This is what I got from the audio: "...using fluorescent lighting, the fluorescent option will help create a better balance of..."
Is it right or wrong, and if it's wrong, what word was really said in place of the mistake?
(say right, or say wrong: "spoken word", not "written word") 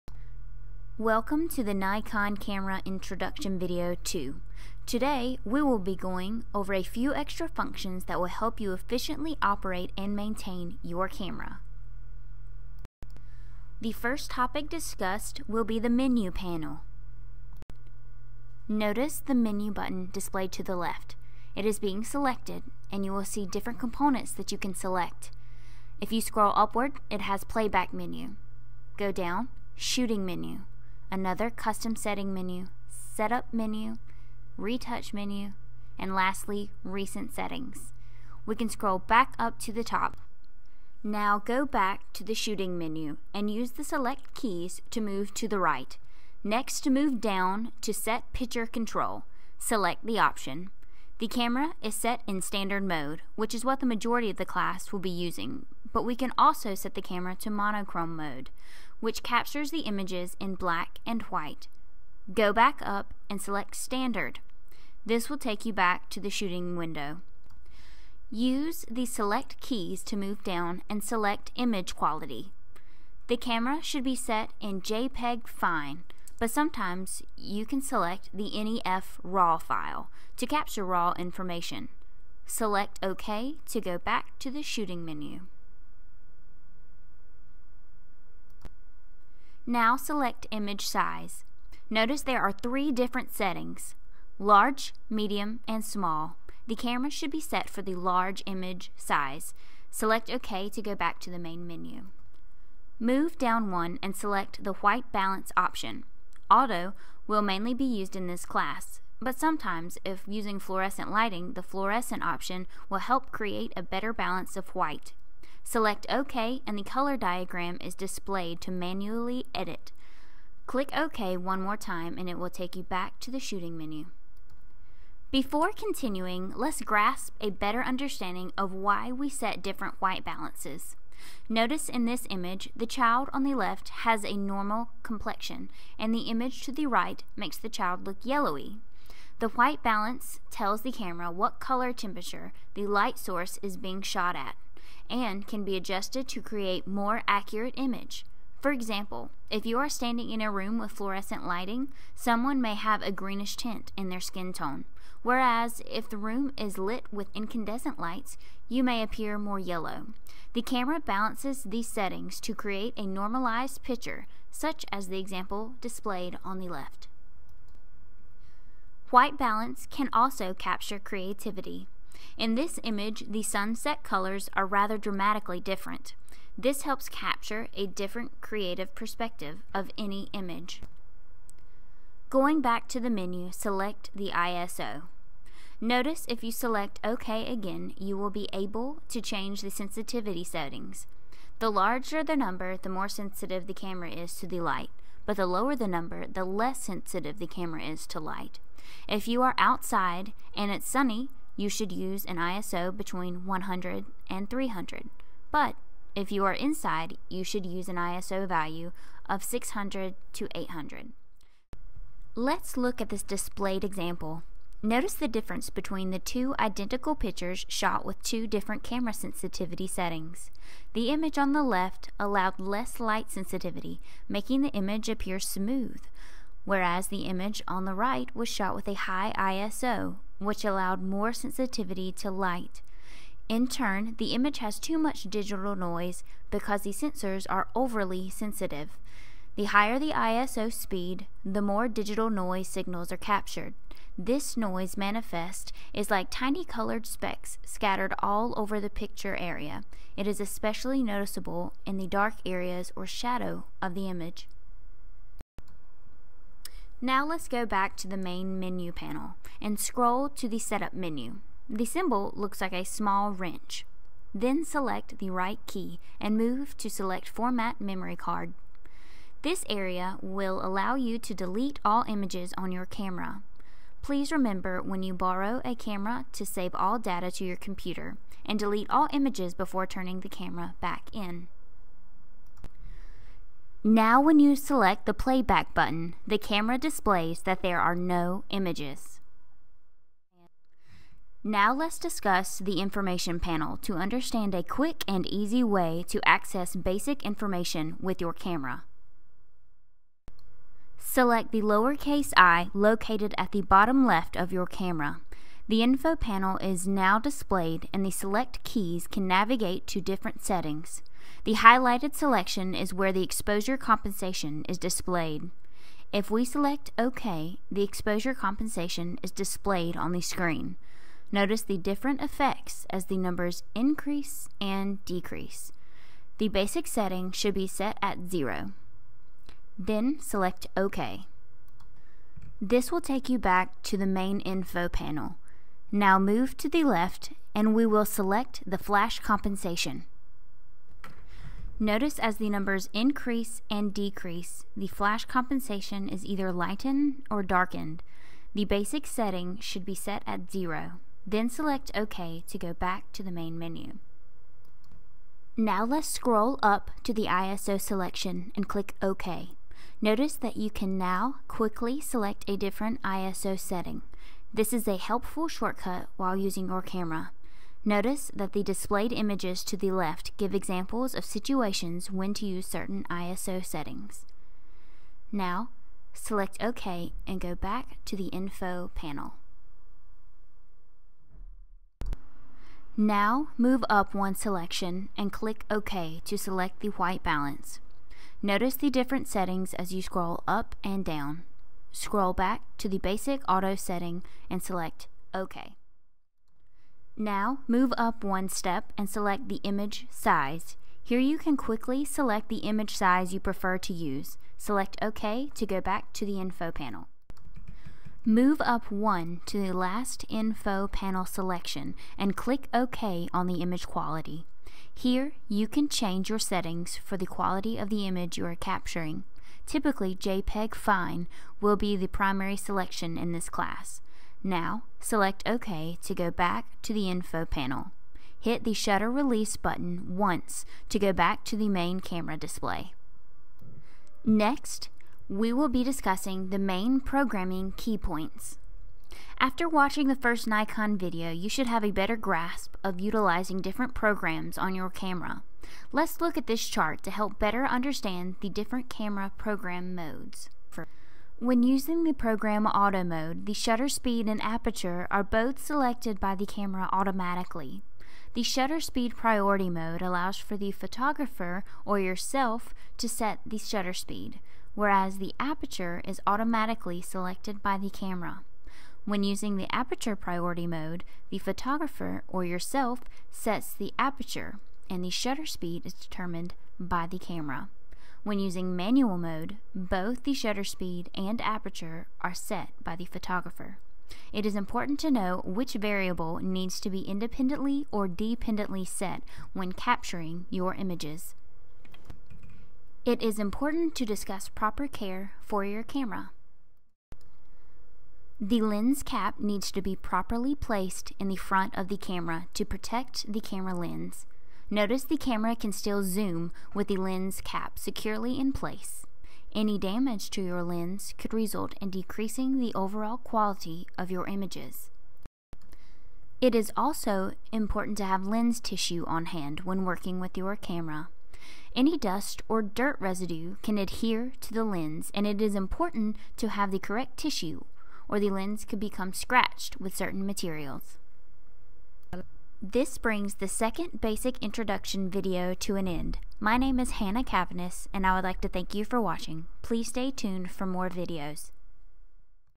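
right.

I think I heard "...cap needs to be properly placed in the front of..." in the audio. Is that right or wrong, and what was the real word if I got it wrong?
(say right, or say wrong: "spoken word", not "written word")
right.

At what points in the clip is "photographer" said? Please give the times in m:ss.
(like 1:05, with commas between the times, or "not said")
7:40, 7:51, 8:03.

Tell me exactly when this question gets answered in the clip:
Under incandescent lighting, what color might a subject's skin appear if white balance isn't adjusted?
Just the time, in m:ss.
2:39.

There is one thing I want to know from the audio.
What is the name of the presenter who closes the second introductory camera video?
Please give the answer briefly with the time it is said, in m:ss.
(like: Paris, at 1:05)
Hannah Cavanis, at 8:56.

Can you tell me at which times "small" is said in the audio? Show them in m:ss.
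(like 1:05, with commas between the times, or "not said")
1:35, 4:22.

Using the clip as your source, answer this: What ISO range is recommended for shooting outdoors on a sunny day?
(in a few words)
100 to 300.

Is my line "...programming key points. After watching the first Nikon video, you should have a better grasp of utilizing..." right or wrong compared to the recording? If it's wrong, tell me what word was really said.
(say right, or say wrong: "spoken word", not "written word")
right.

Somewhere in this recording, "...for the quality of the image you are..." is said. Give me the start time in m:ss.
6:56.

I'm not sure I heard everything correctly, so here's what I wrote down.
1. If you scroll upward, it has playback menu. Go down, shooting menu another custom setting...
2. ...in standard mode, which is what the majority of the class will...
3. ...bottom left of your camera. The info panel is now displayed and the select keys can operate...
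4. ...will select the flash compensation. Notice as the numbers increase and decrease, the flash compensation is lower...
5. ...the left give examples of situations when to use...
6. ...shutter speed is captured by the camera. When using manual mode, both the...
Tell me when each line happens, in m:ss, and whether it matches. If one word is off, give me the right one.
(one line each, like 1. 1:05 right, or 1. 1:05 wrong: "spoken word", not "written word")
1. 0:25 right
2. 0:52 right
3. 5:03 wrong: "navigate", not "operate"
4. 5:37 wrong: "either", not "lower"
5. 6:09 right
6. 7:55 wrong: "determined", not "captured".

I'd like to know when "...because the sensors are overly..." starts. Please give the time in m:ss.
3:56.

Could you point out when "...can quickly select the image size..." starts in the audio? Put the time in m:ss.
6:41.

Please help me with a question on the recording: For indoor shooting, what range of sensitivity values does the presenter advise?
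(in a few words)
600 to 800.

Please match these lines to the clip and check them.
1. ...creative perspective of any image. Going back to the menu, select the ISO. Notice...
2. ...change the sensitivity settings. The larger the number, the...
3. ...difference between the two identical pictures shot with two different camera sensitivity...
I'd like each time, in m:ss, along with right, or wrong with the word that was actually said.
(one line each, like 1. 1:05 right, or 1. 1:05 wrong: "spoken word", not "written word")
1. 2:58 right
2. 3:09 right
3. 3:35 right.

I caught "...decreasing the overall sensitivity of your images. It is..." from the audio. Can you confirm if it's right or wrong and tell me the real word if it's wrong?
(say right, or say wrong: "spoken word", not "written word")
wrong: "quality", not "sensitivity".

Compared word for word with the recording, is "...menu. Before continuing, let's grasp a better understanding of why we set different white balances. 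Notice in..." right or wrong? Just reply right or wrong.
right.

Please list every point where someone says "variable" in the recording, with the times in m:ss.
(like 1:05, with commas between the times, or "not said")
8:05.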